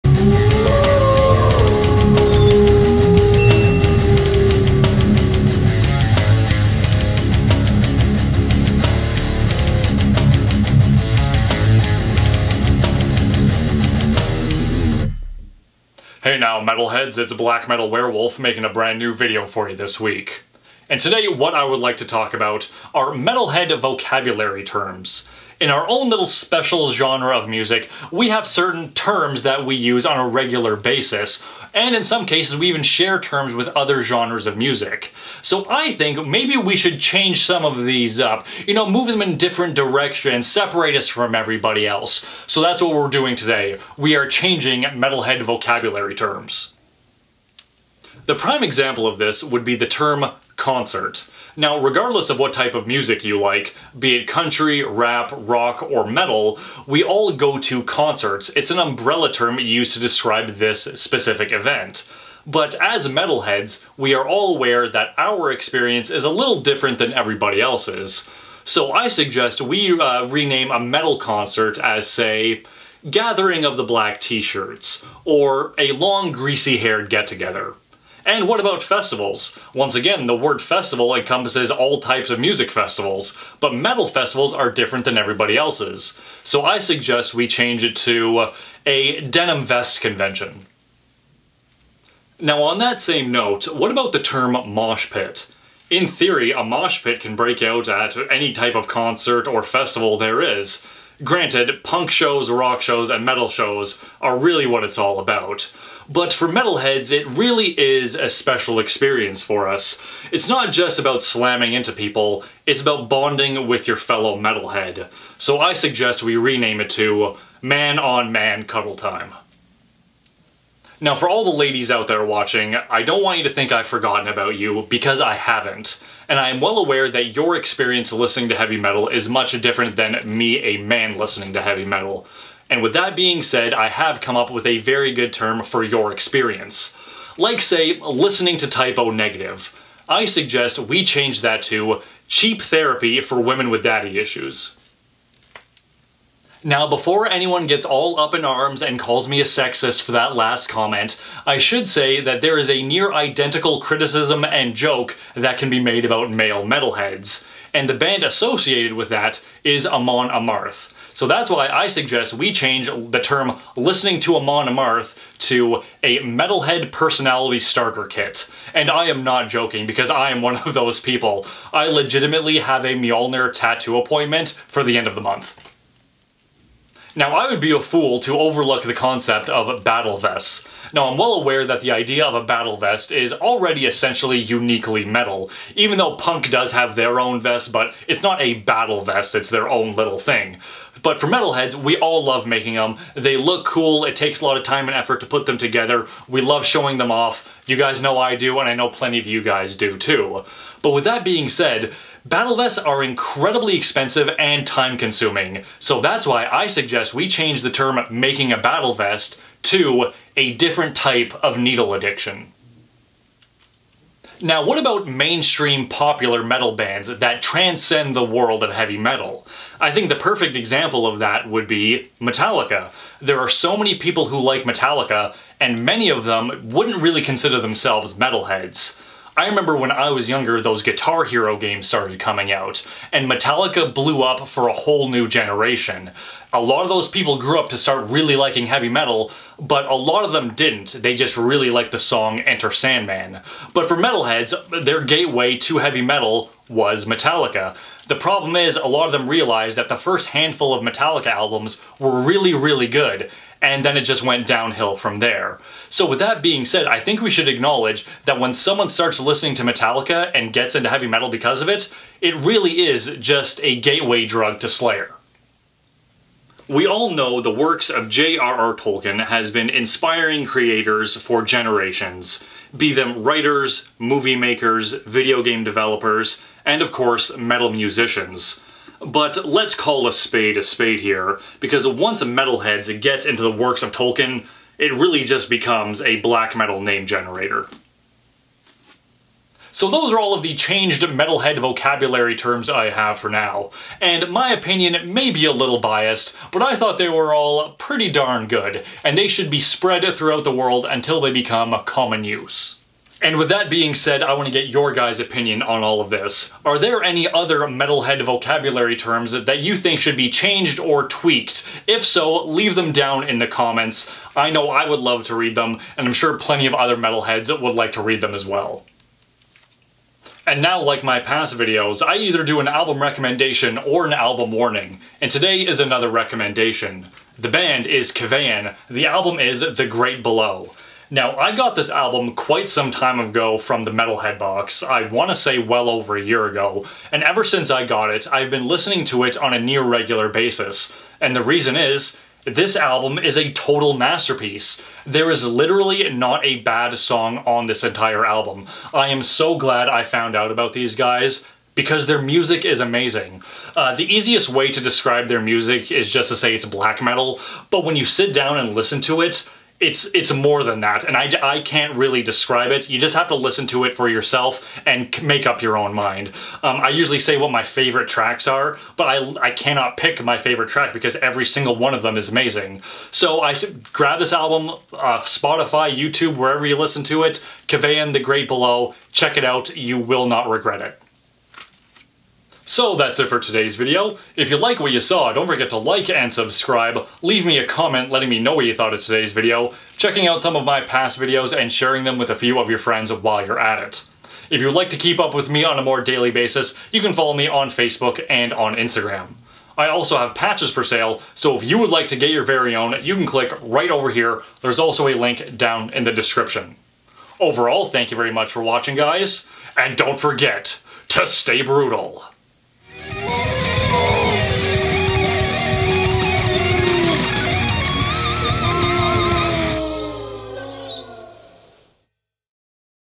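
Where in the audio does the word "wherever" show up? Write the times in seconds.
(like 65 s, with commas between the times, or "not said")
376 s.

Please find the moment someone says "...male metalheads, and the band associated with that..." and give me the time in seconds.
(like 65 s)
156 s.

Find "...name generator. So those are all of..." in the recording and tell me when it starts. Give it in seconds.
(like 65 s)
286 s.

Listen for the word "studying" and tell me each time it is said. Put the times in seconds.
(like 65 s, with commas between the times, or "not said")
not said.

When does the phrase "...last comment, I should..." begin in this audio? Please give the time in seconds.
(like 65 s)
150 s.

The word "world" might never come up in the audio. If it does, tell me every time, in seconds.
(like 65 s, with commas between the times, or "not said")
218 s, 300 s.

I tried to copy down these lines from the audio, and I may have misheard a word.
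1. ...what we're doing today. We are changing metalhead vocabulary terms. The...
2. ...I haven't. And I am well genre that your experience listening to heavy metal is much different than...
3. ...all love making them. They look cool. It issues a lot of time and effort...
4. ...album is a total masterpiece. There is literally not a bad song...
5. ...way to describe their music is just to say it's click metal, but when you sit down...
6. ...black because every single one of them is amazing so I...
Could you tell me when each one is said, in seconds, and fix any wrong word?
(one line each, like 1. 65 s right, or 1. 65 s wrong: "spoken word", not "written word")
1. 42 s right
2. 125 s wrong: "aware", not "genre"
3. 191 s wrong: "takes", not "issues"
4. 342 s right
5. 354 s wrong: "black", not "click"
6. 370 s wrong: "track", not "black".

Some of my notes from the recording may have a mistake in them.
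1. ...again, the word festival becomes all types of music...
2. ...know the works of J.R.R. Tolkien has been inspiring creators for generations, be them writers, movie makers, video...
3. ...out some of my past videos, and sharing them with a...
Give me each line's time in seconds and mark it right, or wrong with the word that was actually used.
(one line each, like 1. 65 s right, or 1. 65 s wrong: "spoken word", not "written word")
1. 79 s wrong: "encompasses", not "becomes"
2. 267 s right
3. 390 s right.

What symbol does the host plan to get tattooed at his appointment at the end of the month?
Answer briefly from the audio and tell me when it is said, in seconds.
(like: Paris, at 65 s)
Mjolnir, at 172 s.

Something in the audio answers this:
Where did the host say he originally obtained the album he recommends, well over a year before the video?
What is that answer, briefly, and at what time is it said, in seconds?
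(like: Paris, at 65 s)
the Metalhead box, at 333 s.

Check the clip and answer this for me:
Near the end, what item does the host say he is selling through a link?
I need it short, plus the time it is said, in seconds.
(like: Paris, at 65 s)
Patches, at 400 s.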